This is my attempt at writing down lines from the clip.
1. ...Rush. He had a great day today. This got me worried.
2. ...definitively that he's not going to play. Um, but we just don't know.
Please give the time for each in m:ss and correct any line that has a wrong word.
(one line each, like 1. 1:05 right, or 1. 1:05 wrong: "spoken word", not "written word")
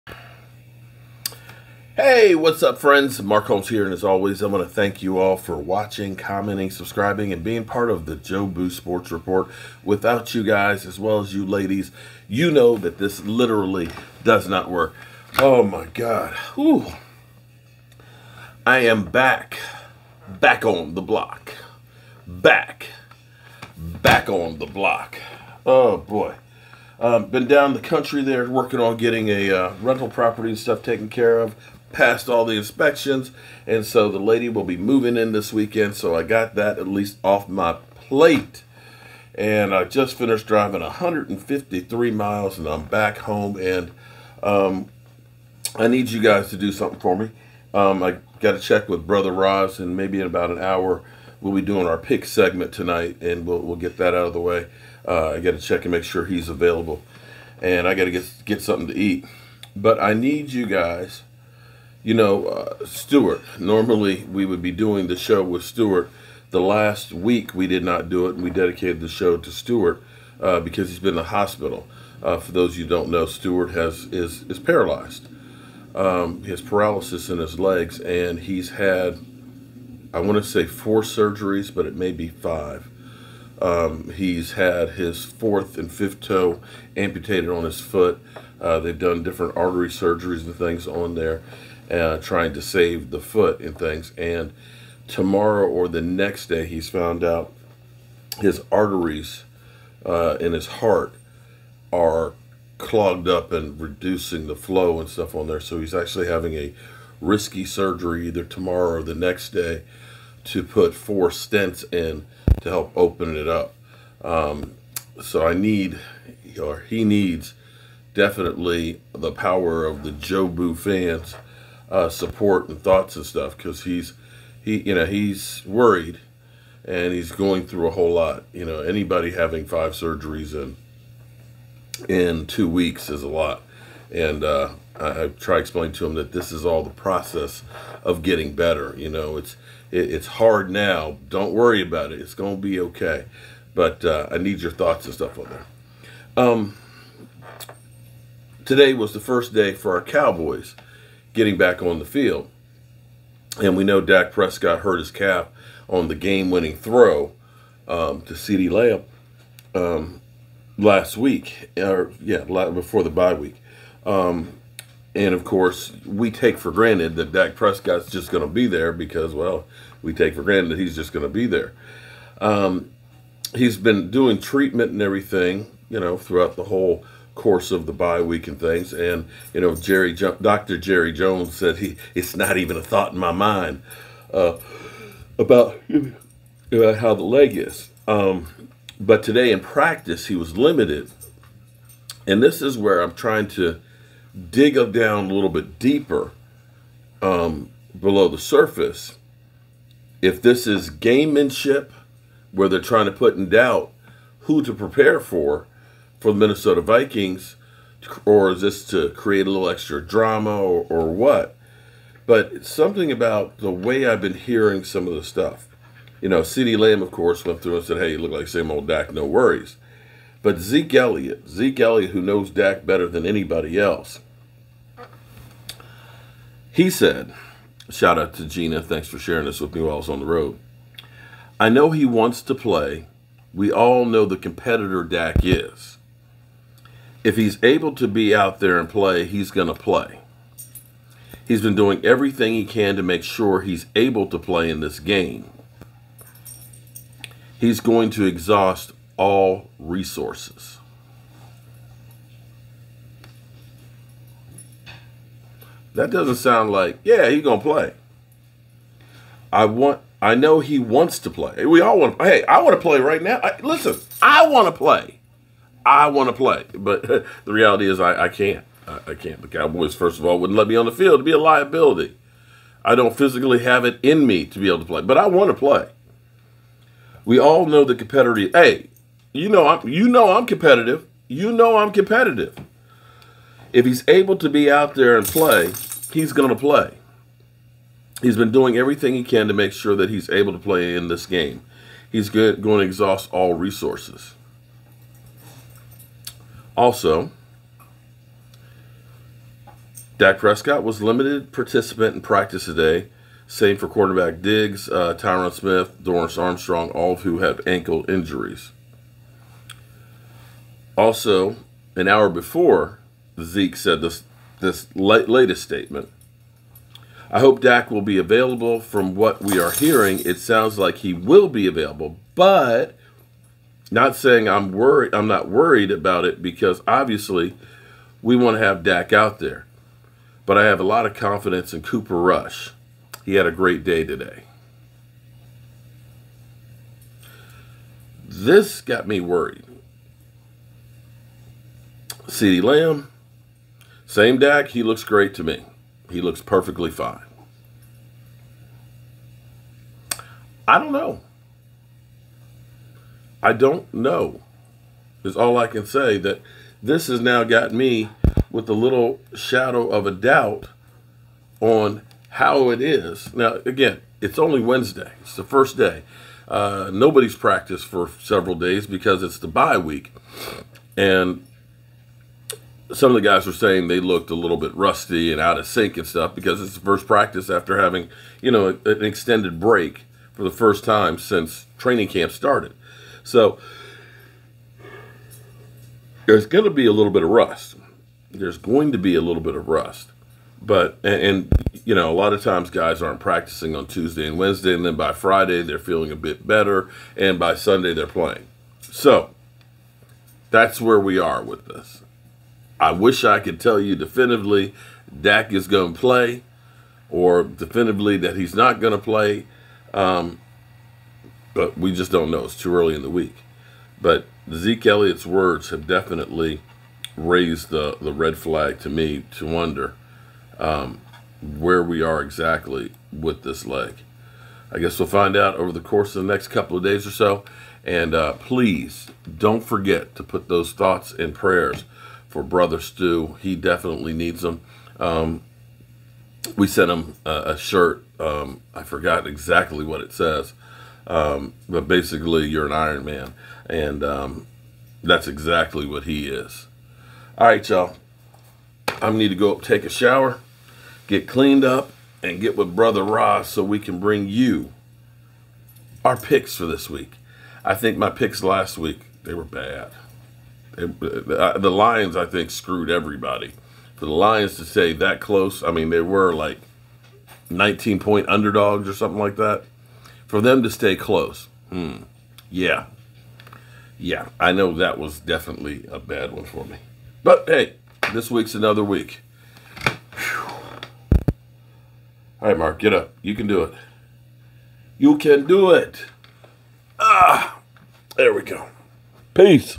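1. 5:32 right
2. 6:47 right.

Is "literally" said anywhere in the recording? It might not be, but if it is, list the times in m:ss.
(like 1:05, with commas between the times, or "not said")
0:13.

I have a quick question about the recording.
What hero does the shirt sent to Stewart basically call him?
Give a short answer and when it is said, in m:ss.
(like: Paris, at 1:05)
Iron Man, at 7:22.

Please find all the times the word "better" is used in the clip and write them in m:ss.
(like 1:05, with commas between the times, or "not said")
2:18, 3:42, 6:36.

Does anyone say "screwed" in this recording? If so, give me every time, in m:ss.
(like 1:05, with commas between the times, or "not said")
7:42.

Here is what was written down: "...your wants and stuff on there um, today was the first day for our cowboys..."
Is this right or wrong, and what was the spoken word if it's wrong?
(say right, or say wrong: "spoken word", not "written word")
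wrong: "thoughts", not "wants".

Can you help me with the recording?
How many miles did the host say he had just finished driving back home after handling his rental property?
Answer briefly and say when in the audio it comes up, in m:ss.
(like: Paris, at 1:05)
153, at 0:40.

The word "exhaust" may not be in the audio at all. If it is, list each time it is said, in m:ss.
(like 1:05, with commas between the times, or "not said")
4:08, 4:52.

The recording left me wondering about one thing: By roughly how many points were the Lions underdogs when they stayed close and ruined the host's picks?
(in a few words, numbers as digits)
19.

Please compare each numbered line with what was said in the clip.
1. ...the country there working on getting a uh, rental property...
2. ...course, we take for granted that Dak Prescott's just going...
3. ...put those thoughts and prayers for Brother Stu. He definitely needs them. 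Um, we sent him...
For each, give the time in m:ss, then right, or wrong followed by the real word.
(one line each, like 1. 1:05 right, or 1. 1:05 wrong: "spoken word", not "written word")
1. 0:27 right
2. 2:45 right
3. 7:10 right.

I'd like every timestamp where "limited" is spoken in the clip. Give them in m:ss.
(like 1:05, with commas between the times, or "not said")
3:10, 5:01.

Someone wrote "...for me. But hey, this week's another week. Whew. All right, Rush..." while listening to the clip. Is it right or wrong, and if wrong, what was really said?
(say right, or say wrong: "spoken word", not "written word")
wrong: "Mark", not "Rush".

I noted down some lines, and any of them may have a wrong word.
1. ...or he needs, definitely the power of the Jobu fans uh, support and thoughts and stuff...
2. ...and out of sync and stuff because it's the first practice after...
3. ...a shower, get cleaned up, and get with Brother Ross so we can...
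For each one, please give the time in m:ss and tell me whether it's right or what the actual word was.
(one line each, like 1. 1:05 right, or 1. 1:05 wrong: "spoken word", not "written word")
1. 1:56 right
2. 6:15 right
3. 7:29 right.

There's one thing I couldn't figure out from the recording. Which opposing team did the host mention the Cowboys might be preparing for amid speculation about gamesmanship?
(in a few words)
Minnesota Vikings.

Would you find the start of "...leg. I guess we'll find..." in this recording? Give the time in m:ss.
7:03.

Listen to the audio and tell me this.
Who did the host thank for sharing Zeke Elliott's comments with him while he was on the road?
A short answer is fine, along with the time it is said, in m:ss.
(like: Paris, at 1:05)
Gina, at 3:48.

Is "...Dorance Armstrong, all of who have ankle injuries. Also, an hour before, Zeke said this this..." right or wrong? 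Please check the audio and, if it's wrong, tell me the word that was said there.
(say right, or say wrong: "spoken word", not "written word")
right.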